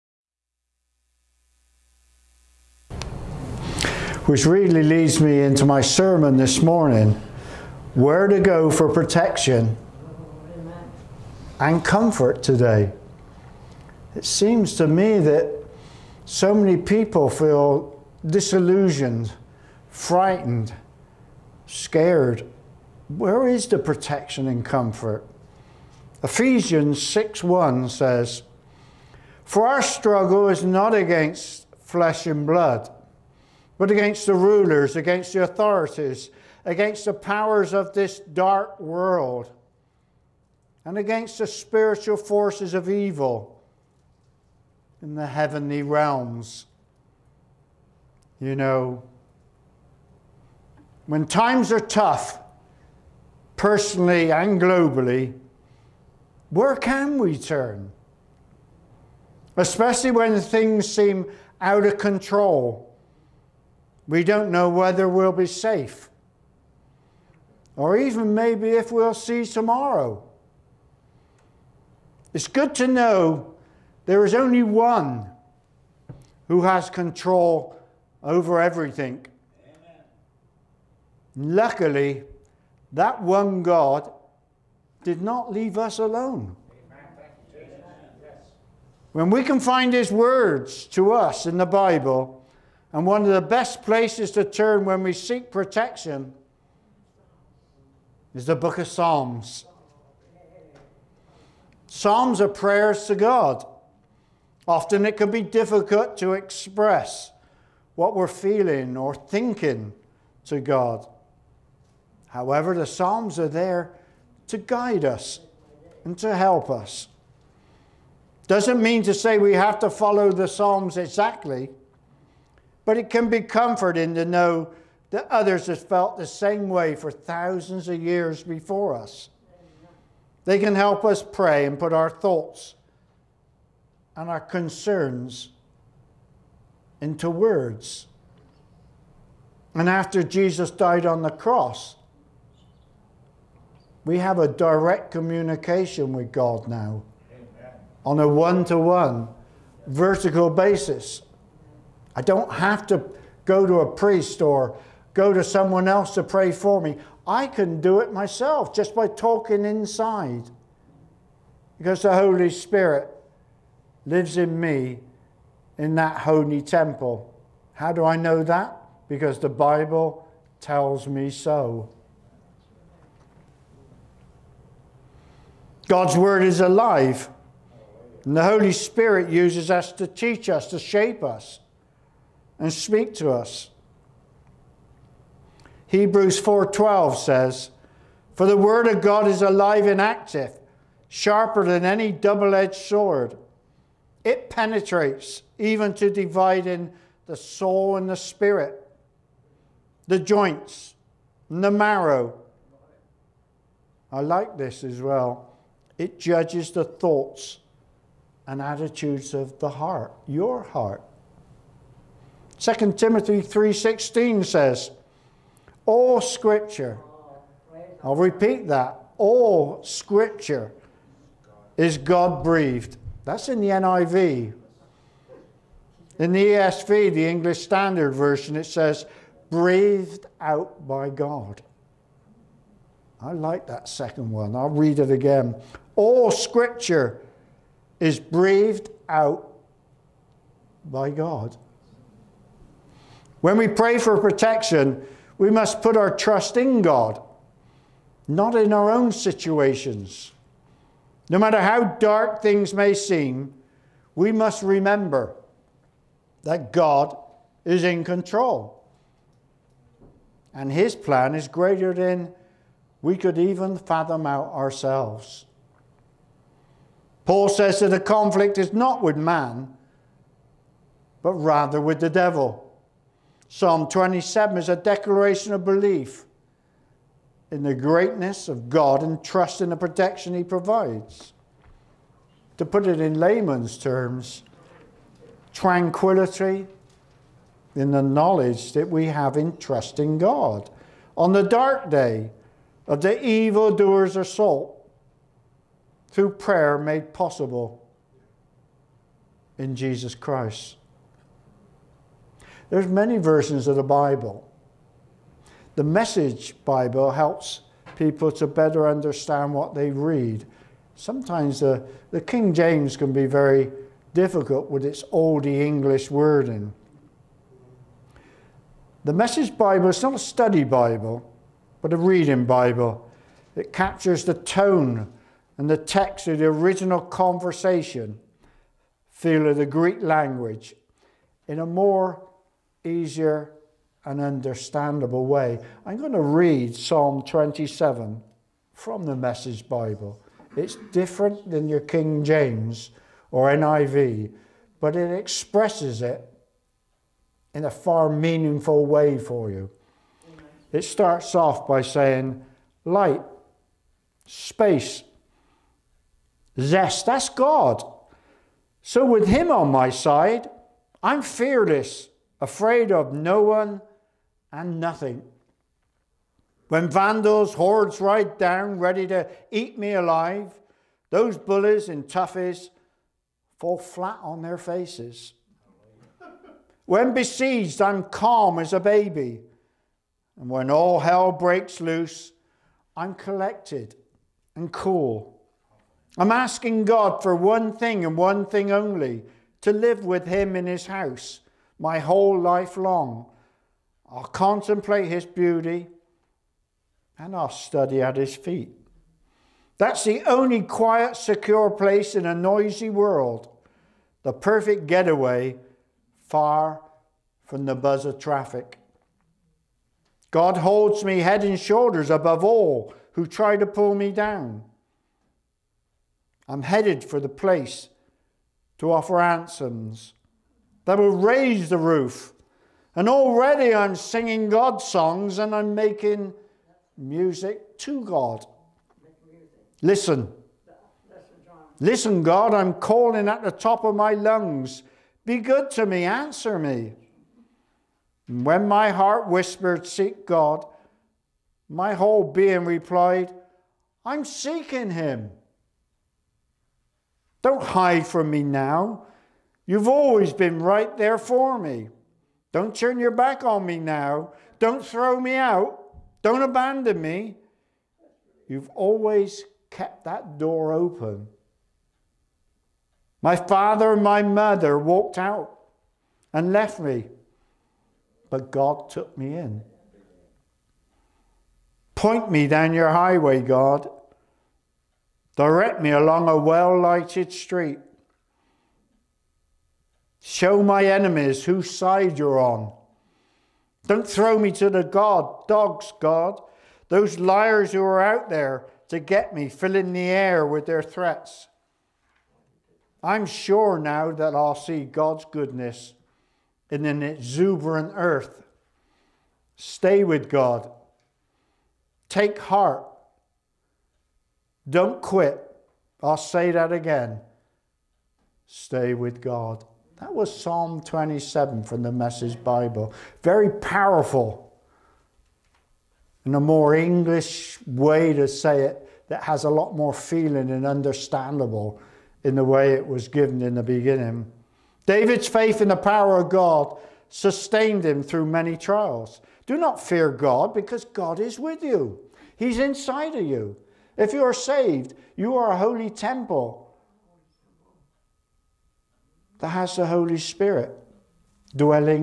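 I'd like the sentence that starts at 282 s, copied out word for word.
To put it in layman's terms, tranquility in the knowledge that we have in trusting God.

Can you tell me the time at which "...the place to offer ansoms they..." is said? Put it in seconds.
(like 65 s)
417 s.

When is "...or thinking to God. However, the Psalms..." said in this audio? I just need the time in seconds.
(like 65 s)
108 s.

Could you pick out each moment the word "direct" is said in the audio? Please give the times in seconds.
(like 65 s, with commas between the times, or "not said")
144 s, 475 s.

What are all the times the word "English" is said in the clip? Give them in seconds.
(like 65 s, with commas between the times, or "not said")
227 s, 315 s, 516 s.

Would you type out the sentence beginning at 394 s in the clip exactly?
I'll contemplate his beauty and I'll study at his feet.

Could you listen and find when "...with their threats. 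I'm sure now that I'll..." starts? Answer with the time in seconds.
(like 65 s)
490 s.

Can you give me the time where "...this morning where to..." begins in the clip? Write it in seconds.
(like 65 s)
6 s.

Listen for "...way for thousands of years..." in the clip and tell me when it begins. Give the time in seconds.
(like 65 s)
126 s.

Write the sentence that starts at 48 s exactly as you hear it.
You know, when times are tough, personally and globally, where can we turn?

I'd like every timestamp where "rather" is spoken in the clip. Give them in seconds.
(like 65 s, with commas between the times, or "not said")
271 s.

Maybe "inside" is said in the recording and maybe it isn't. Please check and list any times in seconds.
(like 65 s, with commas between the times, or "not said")
159 s, 532 s.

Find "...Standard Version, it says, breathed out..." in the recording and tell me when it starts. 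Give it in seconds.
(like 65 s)
227 s.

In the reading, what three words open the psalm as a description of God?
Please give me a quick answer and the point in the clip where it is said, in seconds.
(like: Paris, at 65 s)
Light, space, zest, at 352 s.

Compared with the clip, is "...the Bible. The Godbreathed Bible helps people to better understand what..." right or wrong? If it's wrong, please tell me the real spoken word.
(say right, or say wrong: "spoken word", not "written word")
wrong: "Message", not "Godbreathed".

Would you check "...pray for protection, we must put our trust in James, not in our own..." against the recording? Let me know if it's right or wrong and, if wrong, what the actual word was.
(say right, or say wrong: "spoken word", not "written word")
wrong: "God", not "James".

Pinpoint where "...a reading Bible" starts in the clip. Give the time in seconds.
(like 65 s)
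321 s.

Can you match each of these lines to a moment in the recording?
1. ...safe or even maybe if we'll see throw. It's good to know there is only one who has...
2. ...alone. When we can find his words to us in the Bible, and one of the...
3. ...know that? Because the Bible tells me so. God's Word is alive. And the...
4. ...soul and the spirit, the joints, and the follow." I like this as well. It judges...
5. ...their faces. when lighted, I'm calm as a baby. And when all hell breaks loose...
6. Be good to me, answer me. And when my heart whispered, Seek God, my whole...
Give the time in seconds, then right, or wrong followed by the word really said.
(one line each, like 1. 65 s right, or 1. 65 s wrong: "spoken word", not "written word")
1. 65 s wrong: "tomorrow", not "throw"
2. 85 s right
3. 168 s right
4. 197 s wrong: "marrow", not "follow"
5. 374 s wrong: "besieged", not "lighted"
6. 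435 s right.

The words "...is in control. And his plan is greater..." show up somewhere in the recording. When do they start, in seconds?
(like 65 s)
257 s.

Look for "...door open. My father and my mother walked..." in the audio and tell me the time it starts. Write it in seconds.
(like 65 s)
460 s.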